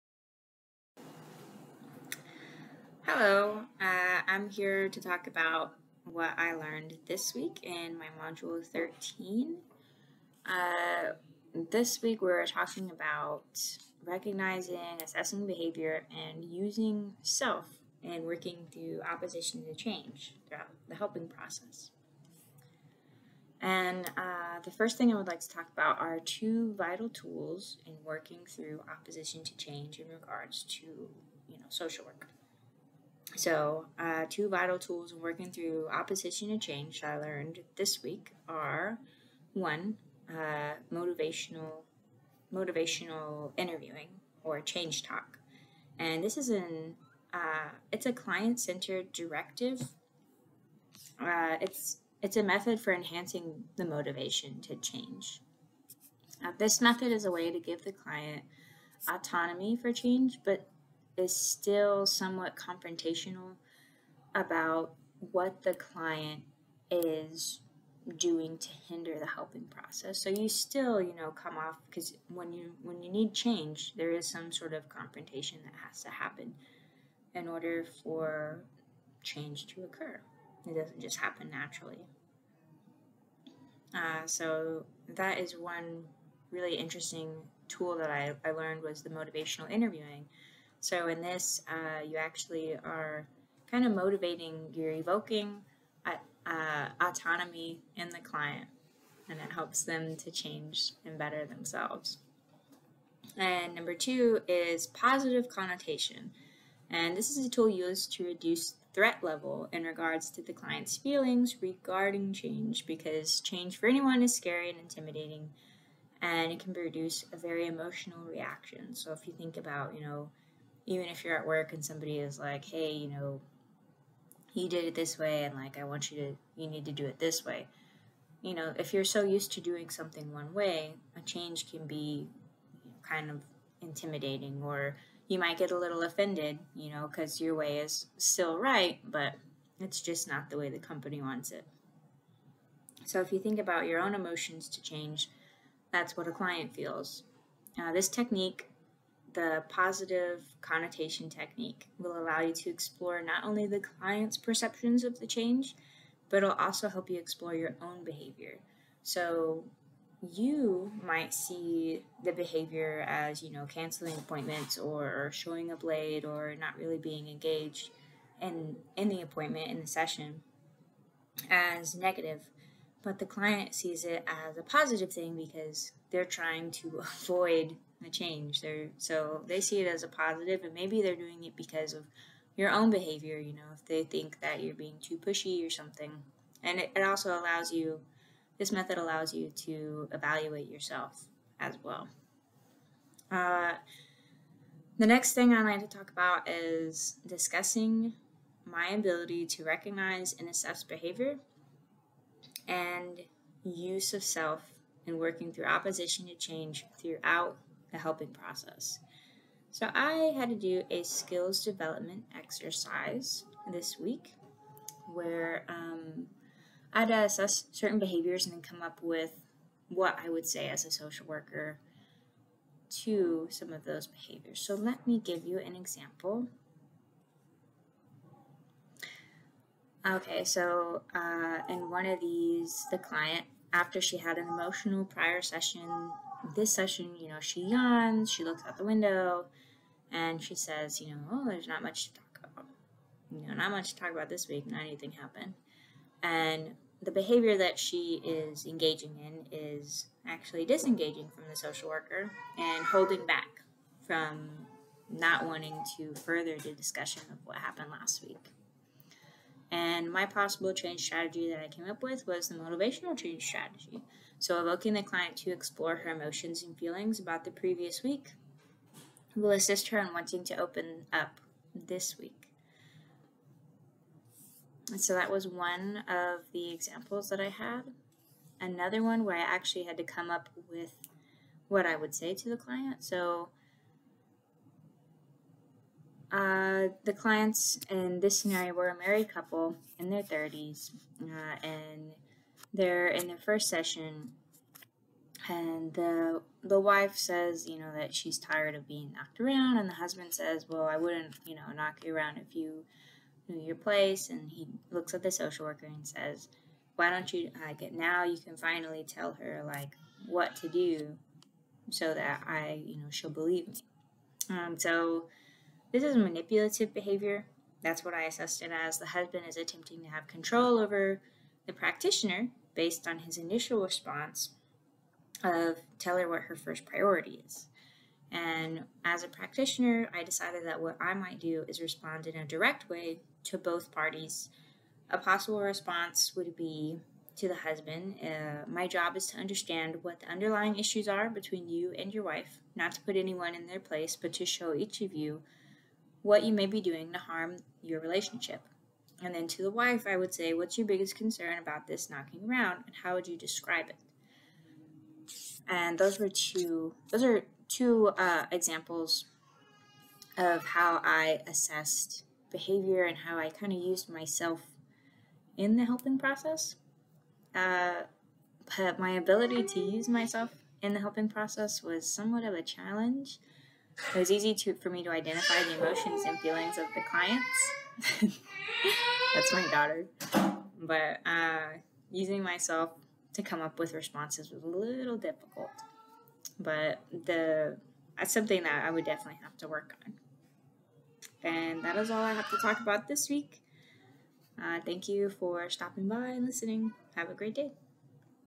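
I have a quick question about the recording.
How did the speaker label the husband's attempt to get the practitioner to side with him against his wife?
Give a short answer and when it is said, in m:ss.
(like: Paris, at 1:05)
Manipulative behavior, at 5:16.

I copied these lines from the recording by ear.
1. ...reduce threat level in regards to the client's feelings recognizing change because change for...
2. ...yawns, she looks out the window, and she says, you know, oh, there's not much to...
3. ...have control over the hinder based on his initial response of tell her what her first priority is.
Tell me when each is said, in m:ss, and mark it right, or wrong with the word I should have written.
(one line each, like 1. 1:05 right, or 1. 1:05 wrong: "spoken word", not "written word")
1. 1:48 wrong: "regarding", not "recognizing"
2. 3:57 right
3. 5:20 wrong: "practitioner", not "hinder".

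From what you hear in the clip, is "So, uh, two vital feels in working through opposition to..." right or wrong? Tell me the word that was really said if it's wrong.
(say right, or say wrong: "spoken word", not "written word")
wrong: "tools", not "feels".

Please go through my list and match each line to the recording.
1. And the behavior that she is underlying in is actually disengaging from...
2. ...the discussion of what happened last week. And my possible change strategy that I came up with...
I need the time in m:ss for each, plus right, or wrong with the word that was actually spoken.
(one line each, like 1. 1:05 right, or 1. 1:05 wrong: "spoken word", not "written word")
1. 4:06 wrong: "engaging", not "underlying"
2. 4:16 right.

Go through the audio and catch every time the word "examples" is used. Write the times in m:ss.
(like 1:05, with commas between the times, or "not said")
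3:45, 4:36, 5:58.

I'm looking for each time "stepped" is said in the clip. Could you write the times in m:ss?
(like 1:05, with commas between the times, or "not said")
not said.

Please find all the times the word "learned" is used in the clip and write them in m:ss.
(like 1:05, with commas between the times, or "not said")
0:06, 0:37, 1:28.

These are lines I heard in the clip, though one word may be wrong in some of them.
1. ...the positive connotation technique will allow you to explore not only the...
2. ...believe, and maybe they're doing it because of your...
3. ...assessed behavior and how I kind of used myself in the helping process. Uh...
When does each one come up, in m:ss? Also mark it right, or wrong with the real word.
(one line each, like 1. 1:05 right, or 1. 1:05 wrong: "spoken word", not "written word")
1. 2:29 right
2. 3:00 wrong: "positive", not "believe"
3. 6:01 right.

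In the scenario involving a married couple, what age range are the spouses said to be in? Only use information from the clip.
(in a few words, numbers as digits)
Their 30s.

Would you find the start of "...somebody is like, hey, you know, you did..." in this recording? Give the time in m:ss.
2:01.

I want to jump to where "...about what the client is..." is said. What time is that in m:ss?
1:04.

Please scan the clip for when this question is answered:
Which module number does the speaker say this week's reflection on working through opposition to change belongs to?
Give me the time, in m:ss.
0:08.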